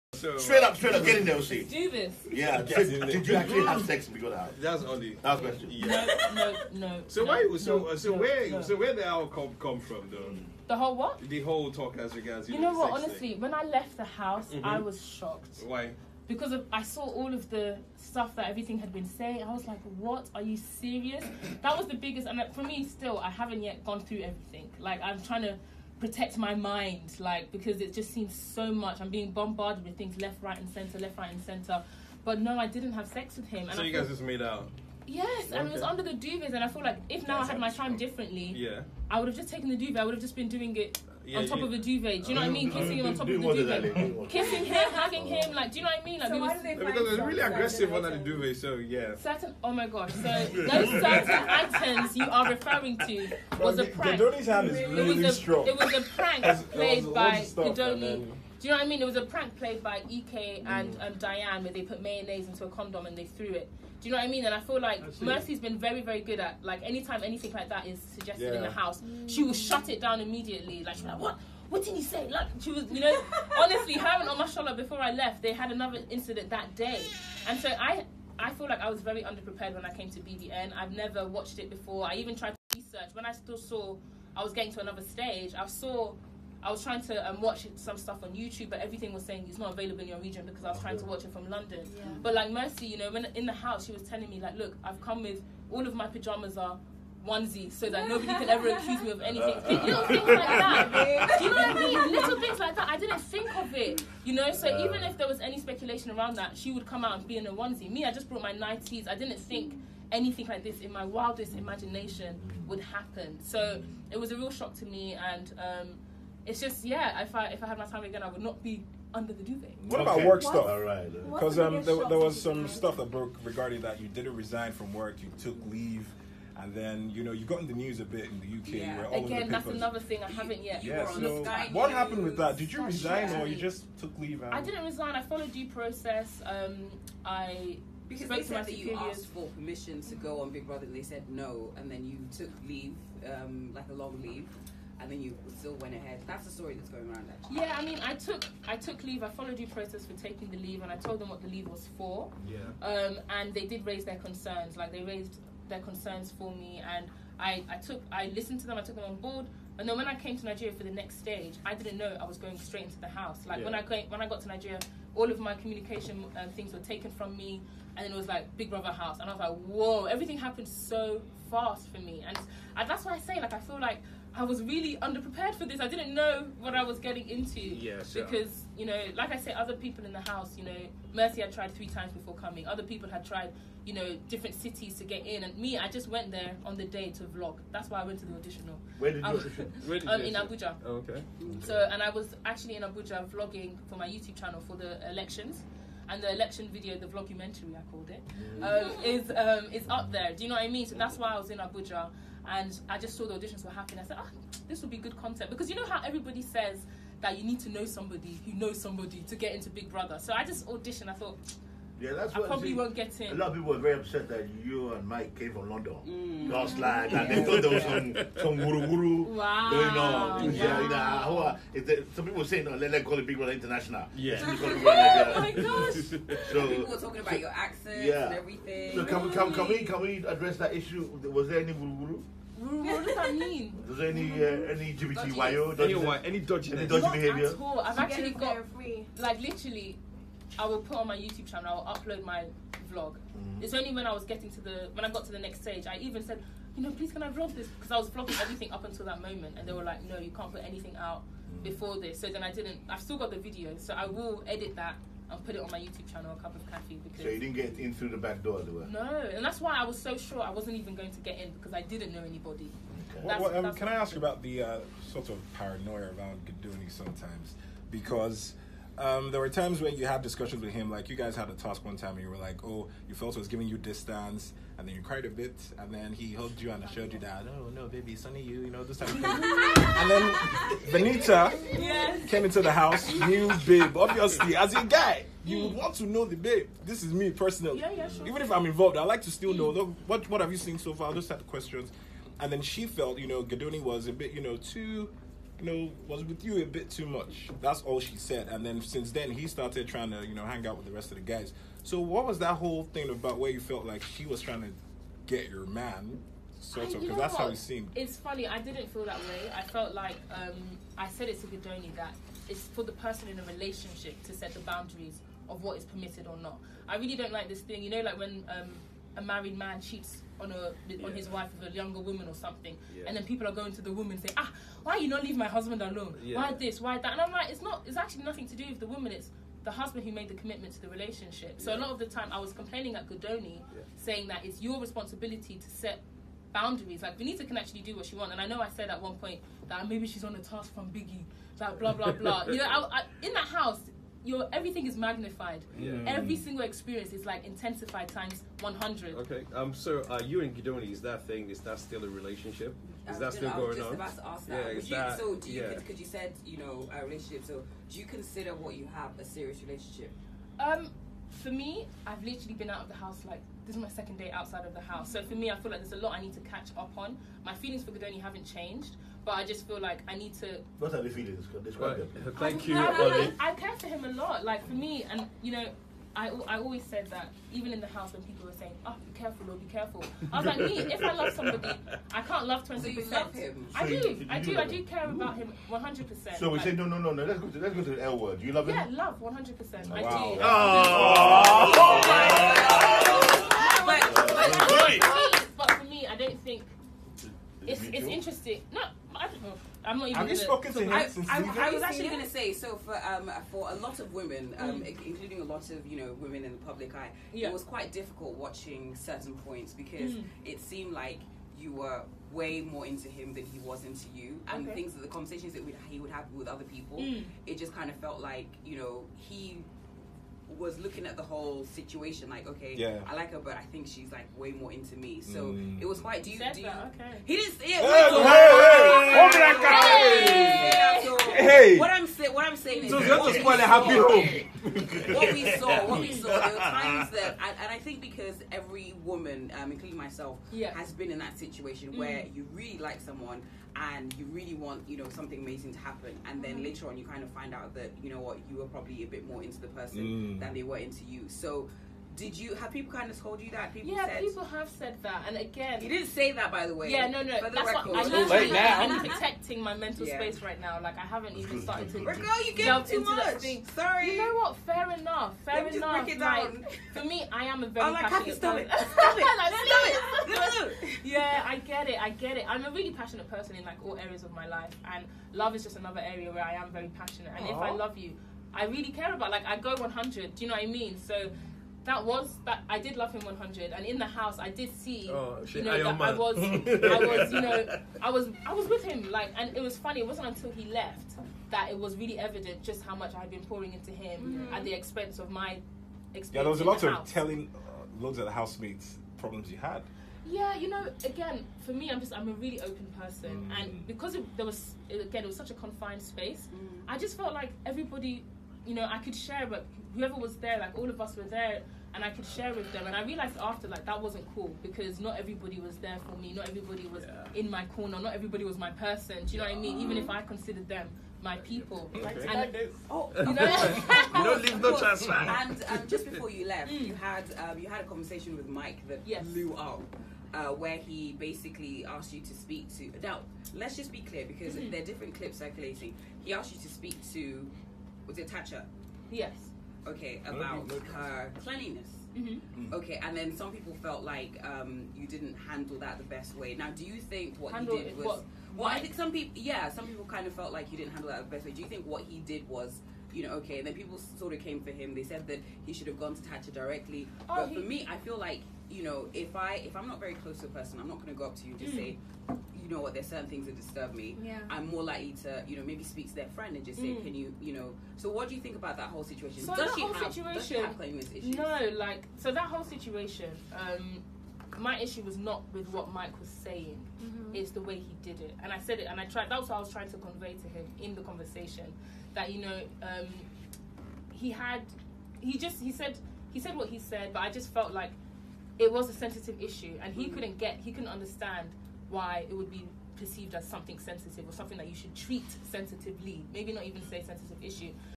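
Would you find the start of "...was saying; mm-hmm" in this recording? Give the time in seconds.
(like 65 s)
576 s.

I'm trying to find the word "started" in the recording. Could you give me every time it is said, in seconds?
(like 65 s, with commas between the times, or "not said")
299 s, 461 s.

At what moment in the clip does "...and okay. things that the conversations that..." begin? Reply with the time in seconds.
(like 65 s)
414 s.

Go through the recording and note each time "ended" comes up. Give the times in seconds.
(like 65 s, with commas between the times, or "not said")
not said.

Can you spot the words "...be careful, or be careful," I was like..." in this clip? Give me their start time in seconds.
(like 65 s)
379 s.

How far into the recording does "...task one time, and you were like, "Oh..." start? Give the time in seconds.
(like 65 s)
271 s.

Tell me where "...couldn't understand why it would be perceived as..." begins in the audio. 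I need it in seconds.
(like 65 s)
590 s.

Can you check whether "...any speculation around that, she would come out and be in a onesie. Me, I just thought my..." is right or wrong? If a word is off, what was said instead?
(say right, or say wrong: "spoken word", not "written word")
wrong: "brought", not "thought".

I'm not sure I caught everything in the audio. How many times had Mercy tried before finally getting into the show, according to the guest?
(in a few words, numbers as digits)
3.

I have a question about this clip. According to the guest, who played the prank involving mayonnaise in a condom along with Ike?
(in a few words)
Diane.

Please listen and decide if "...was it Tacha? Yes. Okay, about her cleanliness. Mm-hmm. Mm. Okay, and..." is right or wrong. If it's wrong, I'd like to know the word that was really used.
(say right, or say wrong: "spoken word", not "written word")
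right.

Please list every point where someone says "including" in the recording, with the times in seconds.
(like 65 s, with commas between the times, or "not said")
405 s, 439 s.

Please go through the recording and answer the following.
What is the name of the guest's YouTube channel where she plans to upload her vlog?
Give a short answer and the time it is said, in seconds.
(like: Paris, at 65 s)
A Cup of Coffee, at 256 s.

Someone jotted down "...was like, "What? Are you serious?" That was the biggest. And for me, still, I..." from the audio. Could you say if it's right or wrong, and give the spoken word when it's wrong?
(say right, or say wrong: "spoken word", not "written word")
right.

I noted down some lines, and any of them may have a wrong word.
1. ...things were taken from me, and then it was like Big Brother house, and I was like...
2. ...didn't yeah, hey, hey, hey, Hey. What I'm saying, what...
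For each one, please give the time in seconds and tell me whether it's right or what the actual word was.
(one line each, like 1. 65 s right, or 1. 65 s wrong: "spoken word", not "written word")
1. 166 s right
2. 427 s right.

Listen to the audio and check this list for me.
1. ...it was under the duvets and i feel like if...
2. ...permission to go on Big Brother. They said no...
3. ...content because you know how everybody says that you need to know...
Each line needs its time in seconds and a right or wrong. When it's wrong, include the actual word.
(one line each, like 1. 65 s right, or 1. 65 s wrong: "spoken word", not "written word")
1. 35 s right
2. 139 s right
3. 205 s right.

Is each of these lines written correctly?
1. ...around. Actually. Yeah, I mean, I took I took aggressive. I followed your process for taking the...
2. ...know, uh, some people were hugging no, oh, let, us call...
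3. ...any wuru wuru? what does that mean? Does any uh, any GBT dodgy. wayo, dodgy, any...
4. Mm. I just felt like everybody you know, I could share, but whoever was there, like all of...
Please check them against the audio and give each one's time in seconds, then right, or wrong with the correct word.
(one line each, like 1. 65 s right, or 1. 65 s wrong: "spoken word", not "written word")
1. 147 s wrong: "leave", not "aggressive"
2. 220 s wrong: "saying", not "hugging"
3. 231 s right
4. 506 s right.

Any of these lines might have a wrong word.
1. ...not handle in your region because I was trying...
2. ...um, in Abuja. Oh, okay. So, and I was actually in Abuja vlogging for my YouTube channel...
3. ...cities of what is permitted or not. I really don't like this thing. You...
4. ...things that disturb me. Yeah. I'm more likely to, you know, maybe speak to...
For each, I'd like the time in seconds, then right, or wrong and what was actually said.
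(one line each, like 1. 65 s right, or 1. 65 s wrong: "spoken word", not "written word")
1. 89 s wrong: "available", not "handle"
2. 190 s right
3. 314 s wrong: "boundaries", not "cities"
4. 563 s right.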